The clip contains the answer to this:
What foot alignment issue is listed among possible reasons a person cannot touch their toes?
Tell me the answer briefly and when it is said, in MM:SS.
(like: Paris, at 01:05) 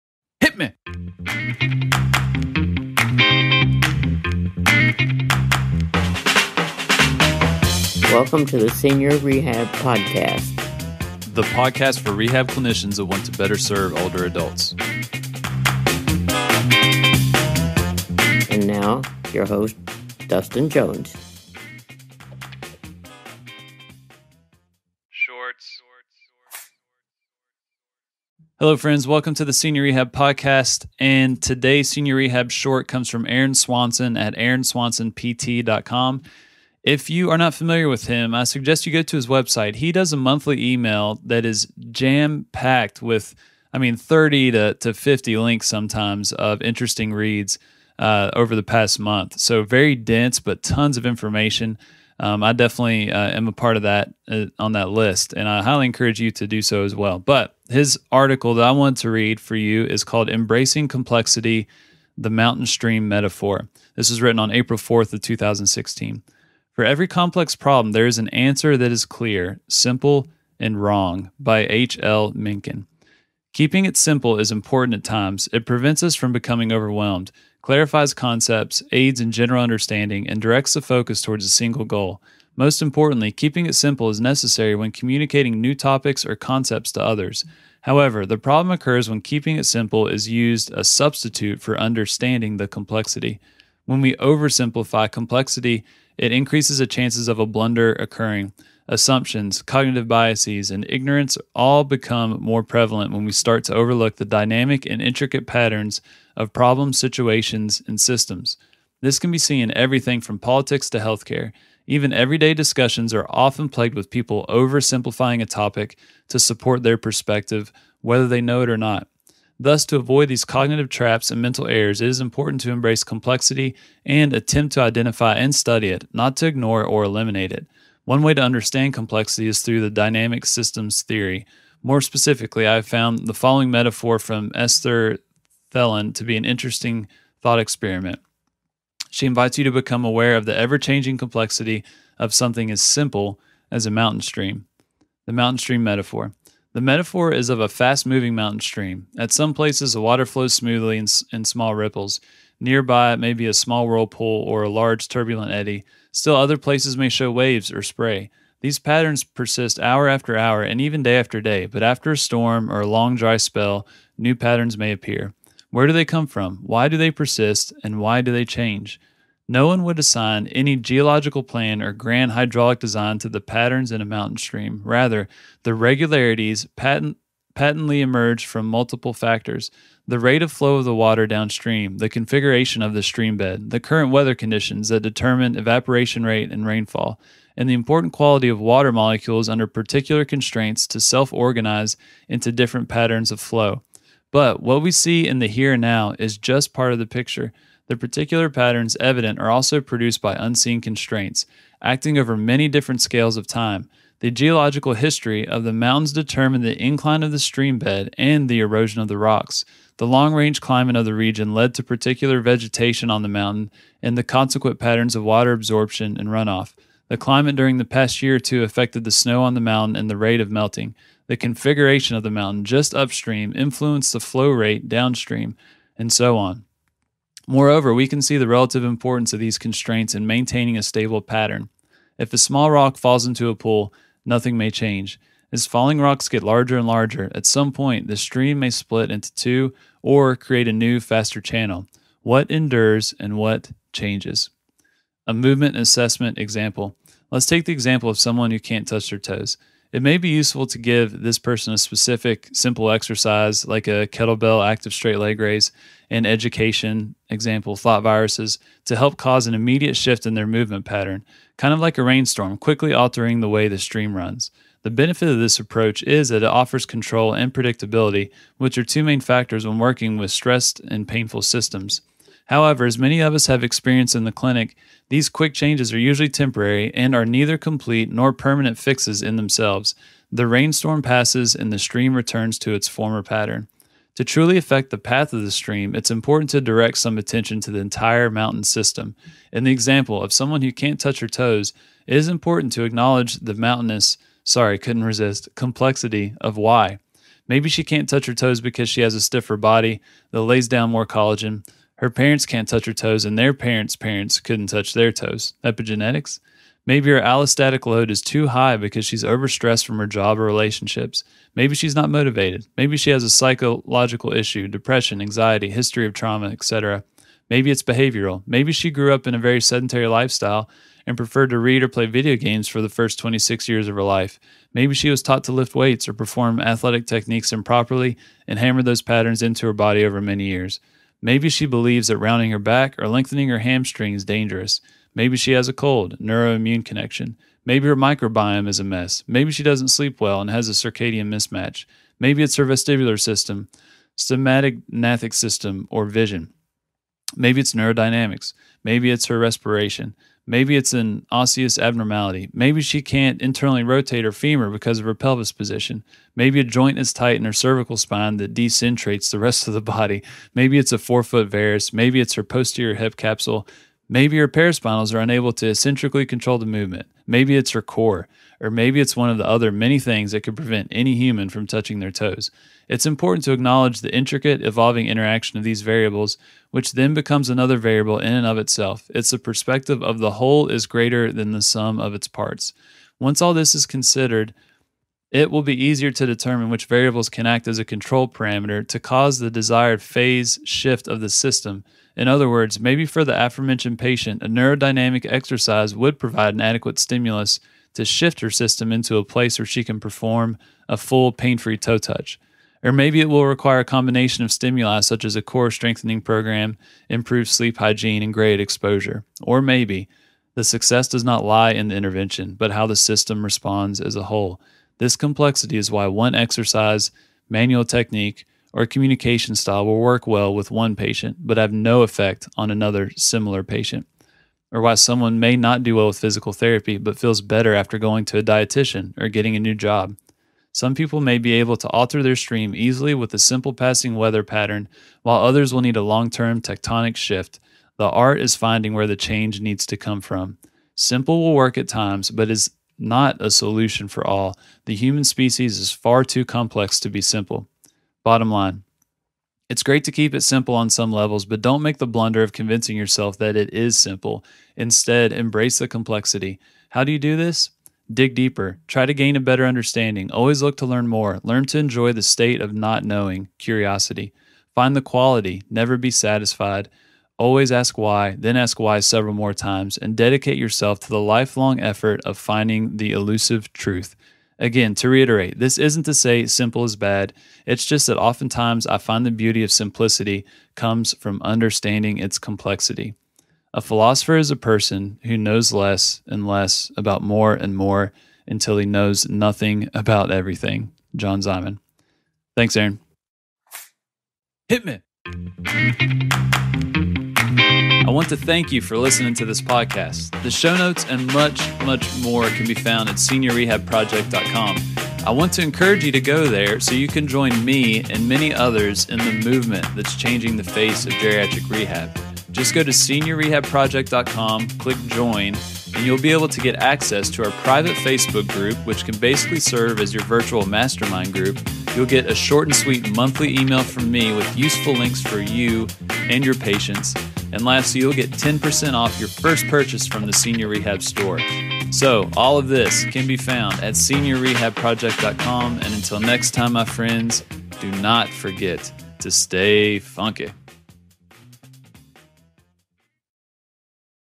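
forefoot varus, at 06:00.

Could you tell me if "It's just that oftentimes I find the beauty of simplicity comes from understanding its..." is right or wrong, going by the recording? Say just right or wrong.
right.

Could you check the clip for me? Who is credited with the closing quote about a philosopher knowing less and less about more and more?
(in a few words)
John Simon.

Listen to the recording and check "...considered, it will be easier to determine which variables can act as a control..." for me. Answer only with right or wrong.
right.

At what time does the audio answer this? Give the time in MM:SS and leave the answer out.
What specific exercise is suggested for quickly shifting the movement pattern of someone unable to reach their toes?
04:14.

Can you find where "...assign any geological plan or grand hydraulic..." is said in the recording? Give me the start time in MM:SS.
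02:49.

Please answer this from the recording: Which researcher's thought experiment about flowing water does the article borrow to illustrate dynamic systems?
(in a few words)
Esther Thelen.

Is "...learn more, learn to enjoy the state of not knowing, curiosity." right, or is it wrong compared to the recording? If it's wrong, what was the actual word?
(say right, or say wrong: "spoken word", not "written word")
right.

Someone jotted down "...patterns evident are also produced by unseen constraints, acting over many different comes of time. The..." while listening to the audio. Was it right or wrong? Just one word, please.
wrong.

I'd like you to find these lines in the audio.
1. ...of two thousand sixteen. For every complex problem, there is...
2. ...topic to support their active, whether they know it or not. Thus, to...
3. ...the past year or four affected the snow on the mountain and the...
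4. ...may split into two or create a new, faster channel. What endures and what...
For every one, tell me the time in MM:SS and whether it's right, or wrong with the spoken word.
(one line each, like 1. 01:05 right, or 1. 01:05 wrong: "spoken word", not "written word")
1. 01:05 right
2. 01:55 wrong: "perspective", not "active"
3. 03:37 wrong: "two", not "four"
4. 03:58 right.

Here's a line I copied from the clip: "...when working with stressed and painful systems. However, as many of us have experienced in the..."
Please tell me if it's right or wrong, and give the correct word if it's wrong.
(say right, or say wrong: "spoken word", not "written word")
right.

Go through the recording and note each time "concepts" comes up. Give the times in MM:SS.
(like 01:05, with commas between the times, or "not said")
01:18, 01:26.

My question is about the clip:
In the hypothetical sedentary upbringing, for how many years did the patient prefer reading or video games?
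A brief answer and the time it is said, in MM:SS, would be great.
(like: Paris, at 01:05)
26, at 05:23.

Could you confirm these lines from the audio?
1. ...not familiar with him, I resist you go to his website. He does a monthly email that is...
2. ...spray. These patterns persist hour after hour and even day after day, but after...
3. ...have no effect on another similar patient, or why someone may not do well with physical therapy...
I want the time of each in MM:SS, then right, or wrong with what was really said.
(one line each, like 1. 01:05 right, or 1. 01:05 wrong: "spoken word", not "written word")
1. 00:37 wrong: "suggest", not "resist"
2. 02:37 right
3. 07:01 right.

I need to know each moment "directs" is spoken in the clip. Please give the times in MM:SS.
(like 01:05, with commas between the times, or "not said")
01:20, 04:46.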